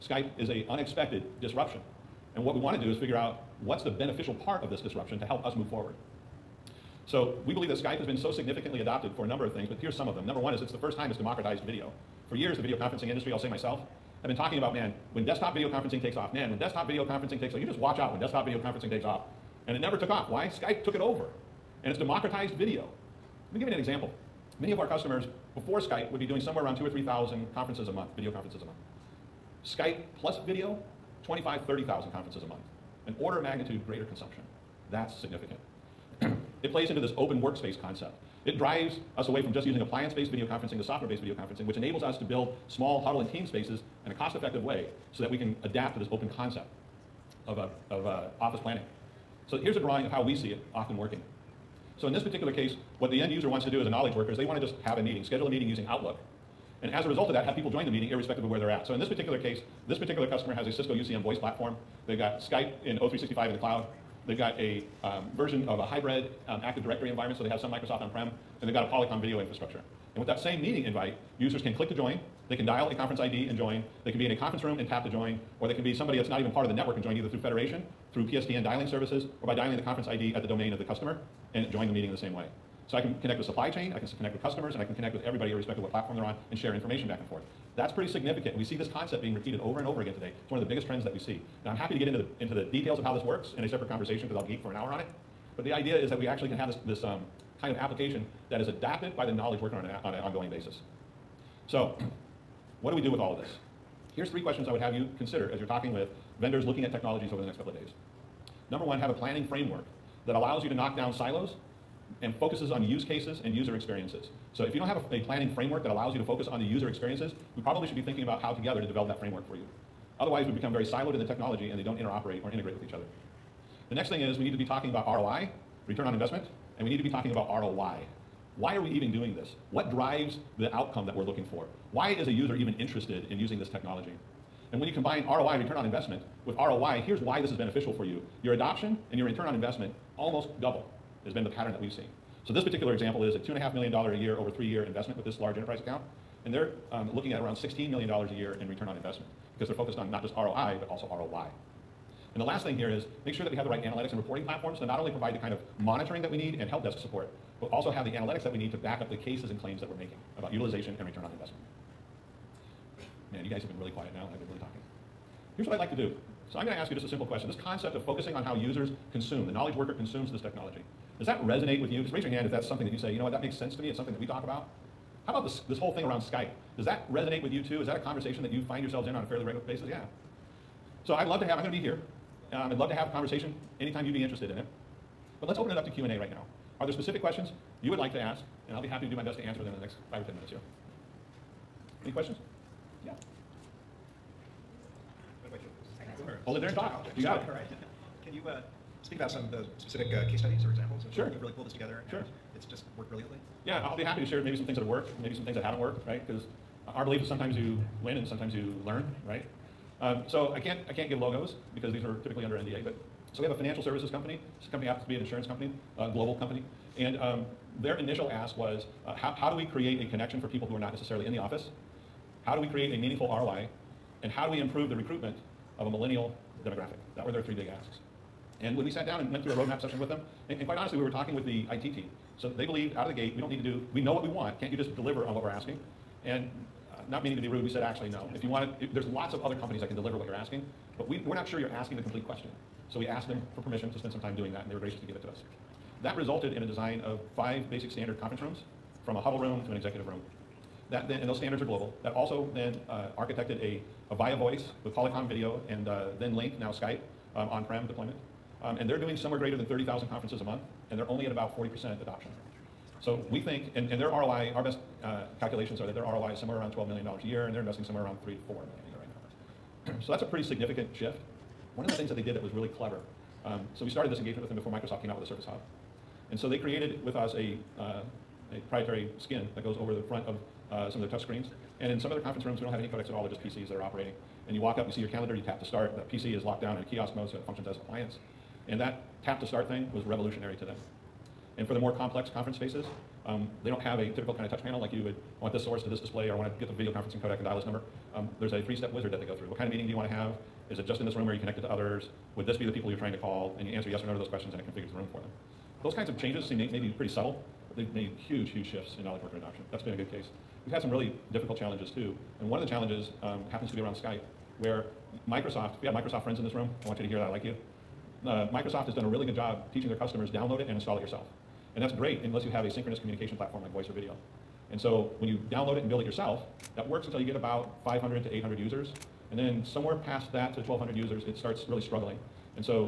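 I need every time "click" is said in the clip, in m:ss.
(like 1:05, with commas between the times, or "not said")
1:11.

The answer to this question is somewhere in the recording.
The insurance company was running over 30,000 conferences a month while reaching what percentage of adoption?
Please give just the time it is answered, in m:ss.
4:21.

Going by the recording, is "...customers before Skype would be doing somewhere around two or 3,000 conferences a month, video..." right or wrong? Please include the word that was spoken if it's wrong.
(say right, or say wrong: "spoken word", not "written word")
right.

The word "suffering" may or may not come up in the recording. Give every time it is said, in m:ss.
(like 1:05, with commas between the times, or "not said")
not said.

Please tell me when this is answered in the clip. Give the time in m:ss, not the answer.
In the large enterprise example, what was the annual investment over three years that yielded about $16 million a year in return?
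2:23.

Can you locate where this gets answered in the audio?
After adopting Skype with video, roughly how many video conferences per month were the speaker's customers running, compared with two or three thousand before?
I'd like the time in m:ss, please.
0:31.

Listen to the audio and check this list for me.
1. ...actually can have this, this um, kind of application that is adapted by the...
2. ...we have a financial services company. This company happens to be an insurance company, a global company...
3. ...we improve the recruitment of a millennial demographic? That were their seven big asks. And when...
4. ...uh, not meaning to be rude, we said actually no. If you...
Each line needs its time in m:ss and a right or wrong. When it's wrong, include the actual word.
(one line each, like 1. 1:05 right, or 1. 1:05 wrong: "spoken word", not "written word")
1. 1:36 right
2. 3:33 right
3. 3:44 wrong: "three", not "seven"
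4. 3:56 right.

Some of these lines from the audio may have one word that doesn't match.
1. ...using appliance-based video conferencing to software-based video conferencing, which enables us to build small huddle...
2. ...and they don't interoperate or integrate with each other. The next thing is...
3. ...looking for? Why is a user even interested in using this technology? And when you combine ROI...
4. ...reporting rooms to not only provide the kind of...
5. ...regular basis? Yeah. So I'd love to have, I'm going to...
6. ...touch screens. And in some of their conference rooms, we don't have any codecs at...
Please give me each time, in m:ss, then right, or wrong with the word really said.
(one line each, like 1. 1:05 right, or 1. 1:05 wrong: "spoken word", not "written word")
1. 0:39 right
2. 2:01 right
3. 2:11 right
4. 2:34 wrong: "platforms", not "rooms"
5. 2:59 right
6. 4:41 right.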